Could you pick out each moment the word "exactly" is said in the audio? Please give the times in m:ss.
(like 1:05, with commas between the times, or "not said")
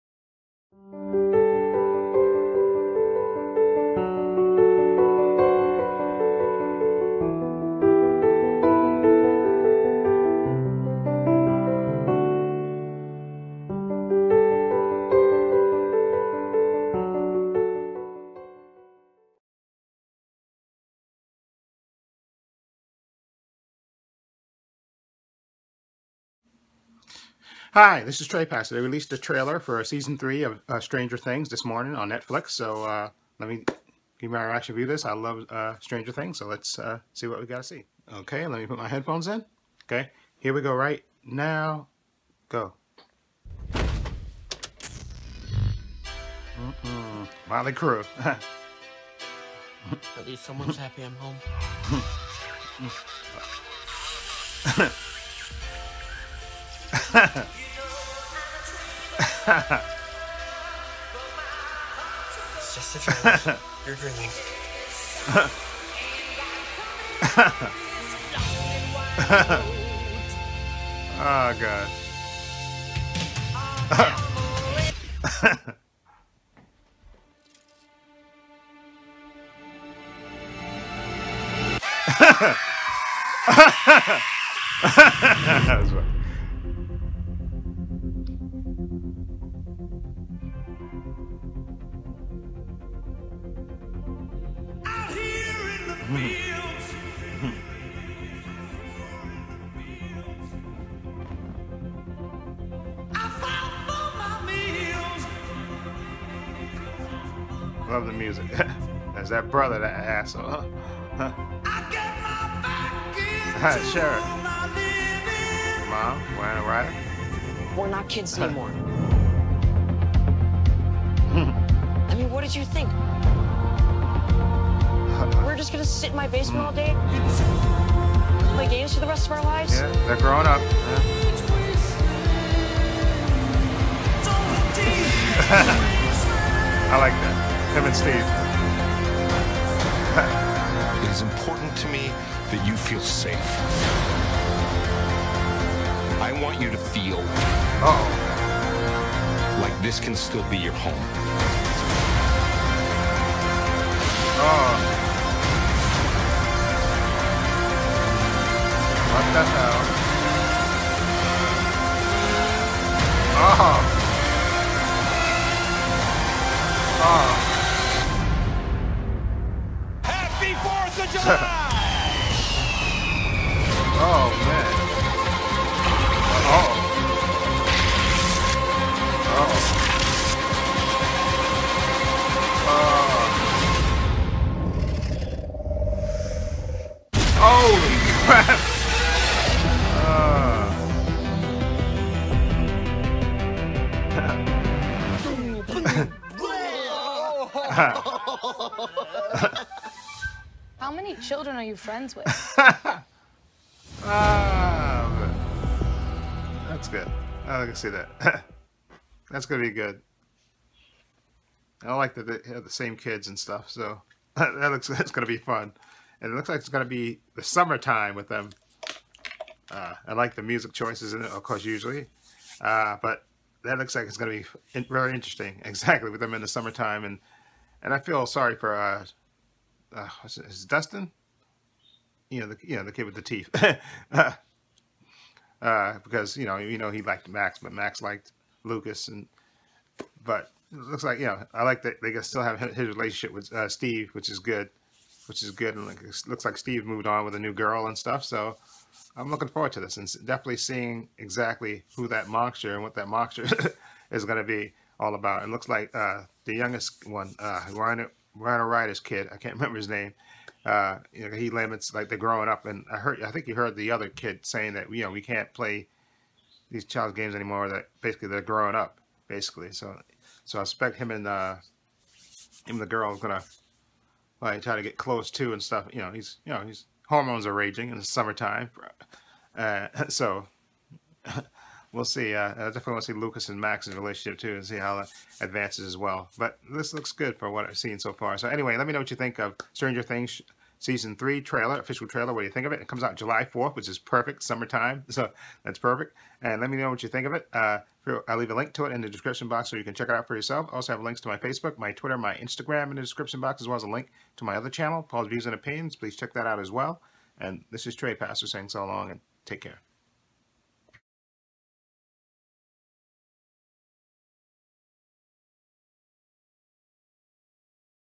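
3:45, 4:11.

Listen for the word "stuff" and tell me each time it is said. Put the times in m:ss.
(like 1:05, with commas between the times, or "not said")
3:33, 4:07, 4:35.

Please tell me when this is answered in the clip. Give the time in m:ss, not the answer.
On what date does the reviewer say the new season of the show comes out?
4:53.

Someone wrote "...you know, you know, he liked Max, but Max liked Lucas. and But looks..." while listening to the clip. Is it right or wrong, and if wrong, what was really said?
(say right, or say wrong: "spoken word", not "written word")
right.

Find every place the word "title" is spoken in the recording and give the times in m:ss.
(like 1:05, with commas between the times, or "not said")
not said.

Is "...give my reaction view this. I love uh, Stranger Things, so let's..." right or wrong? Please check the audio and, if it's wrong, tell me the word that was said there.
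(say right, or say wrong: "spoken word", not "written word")
right.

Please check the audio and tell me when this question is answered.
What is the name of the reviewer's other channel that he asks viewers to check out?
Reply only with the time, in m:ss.
5:05.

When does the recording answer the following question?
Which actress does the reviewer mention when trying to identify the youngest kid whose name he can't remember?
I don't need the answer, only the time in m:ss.
4:18.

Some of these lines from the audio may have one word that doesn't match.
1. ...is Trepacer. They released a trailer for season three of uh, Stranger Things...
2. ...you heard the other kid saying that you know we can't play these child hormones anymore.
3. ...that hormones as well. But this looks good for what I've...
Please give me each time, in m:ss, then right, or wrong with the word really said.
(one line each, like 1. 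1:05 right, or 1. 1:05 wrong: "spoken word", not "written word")
1. 0:28 right
2. 4:23 wrong: "games", not "hormones"
3. 4:44 wrong: "advances", not "hormones".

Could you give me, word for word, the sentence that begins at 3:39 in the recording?
Uh, I like the music choices in it, of course, usually.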